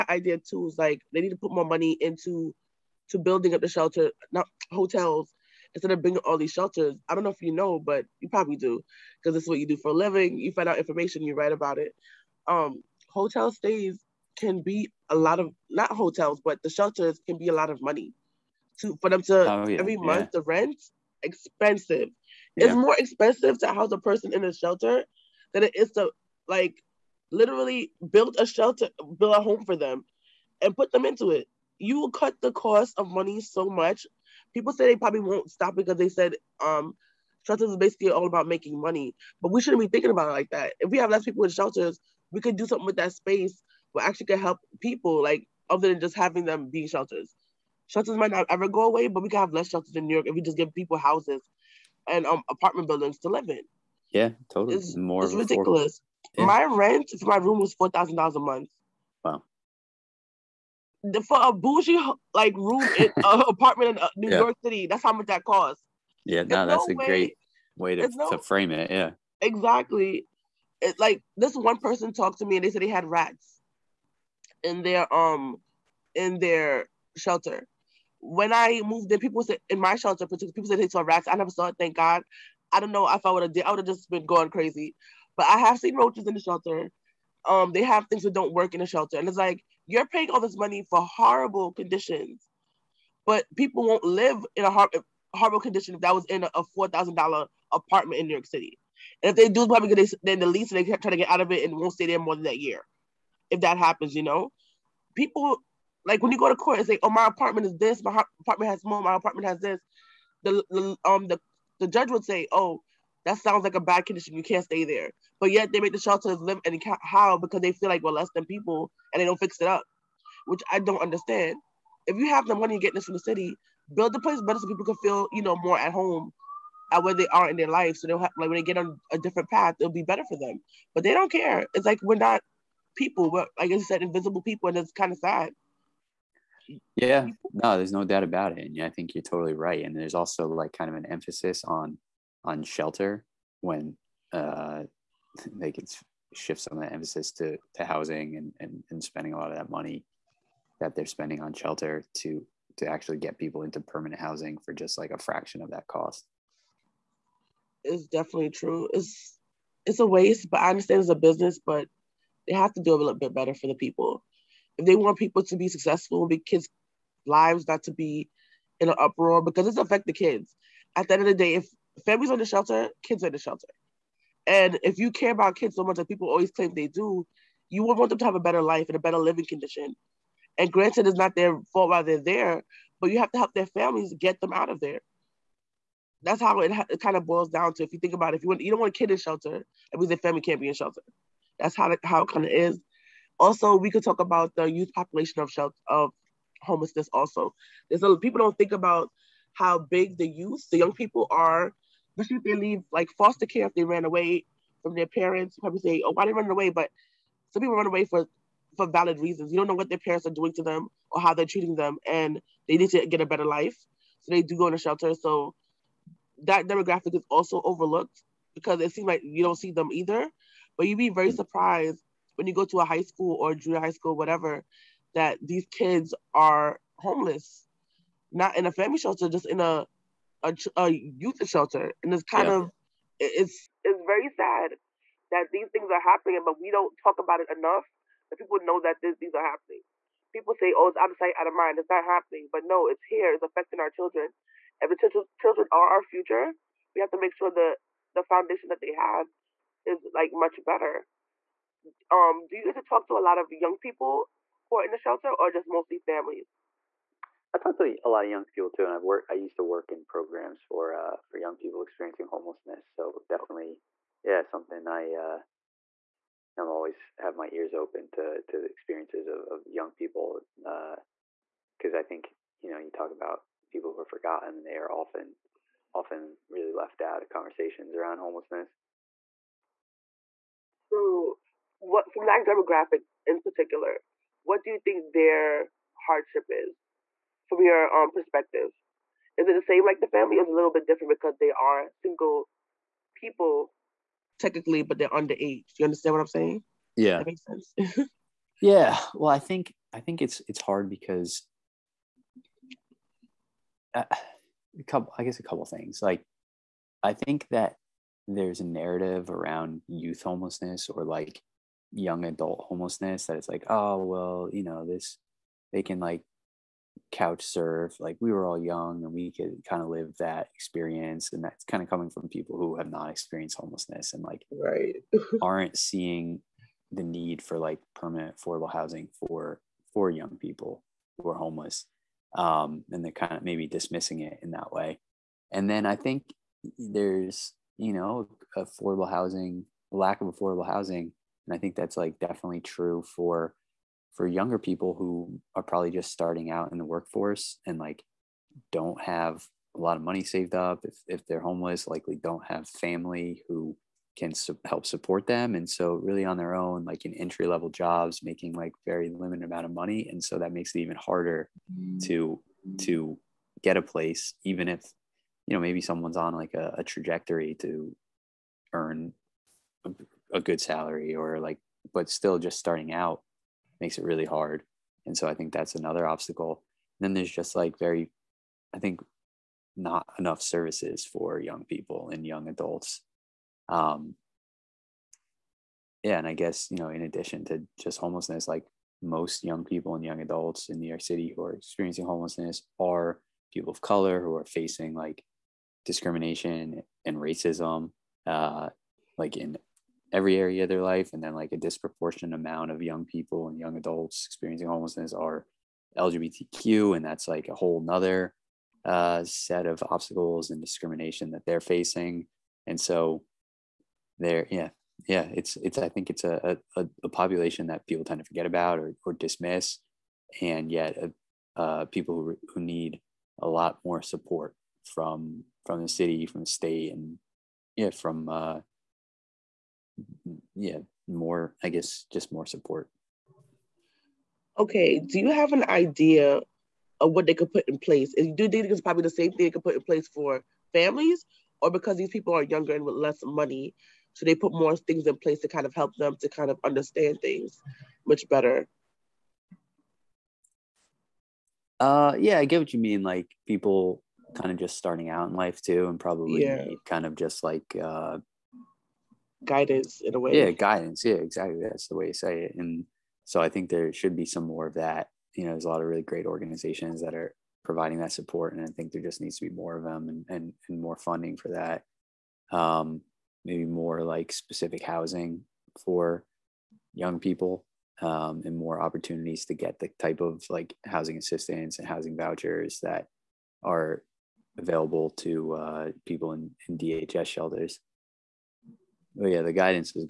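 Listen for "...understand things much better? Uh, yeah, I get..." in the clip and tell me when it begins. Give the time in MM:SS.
07:26.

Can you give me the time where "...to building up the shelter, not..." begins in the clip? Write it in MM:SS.
00:03.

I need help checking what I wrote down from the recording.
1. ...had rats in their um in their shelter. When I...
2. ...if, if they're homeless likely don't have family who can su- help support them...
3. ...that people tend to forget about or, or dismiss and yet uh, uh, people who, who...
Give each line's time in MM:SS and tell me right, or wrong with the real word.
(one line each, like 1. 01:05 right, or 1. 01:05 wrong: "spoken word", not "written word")
1. 01:12 right
2. 05:50 right
3. 06:57 right.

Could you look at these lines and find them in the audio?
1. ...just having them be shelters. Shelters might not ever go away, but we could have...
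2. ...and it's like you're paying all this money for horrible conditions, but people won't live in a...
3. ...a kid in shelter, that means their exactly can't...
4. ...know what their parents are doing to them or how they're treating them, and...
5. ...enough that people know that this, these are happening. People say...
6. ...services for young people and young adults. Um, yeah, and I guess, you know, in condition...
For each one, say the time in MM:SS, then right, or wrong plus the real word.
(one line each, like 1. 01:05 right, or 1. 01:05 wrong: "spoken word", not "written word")
1. 00:45 right
2. 01:29 right
3. 03:08 wrong: "family", not "exactly"
4. 03:29 right
5. 03:57 right
6. 06:20 wrong: "addition", not "condition".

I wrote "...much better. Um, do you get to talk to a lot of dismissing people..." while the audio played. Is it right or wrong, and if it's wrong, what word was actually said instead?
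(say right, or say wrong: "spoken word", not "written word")
wrong: "young", not "dismissing".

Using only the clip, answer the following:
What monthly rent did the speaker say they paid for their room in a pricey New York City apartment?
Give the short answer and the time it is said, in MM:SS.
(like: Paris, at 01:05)
$4,000, at 00:57.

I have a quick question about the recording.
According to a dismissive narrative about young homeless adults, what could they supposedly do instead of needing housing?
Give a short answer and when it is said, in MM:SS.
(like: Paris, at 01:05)
Couch surf, at 05:17.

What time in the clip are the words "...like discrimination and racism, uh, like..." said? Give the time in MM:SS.
06:34.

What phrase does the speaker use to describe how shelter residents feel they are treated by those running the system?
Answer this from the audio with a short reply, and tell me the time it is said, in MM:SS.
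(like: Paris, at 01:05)
Invisible people, at 02:14.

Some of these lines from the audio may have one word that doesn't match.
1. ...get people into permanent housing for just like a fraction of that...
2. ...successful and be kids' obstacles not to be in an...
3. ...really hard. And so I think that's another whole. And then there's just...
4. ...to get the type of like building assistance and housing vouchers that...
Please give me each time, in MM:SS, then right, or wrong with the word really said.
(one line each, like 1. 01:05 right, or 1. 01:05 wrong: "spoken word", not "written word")
1. 02:33 right
2. 02:45 wrong: "lives", not "obstacles"
3. 06:14 wrong: "obstacle", not "whole"
4. 07:59 wrong: "housing", not "building".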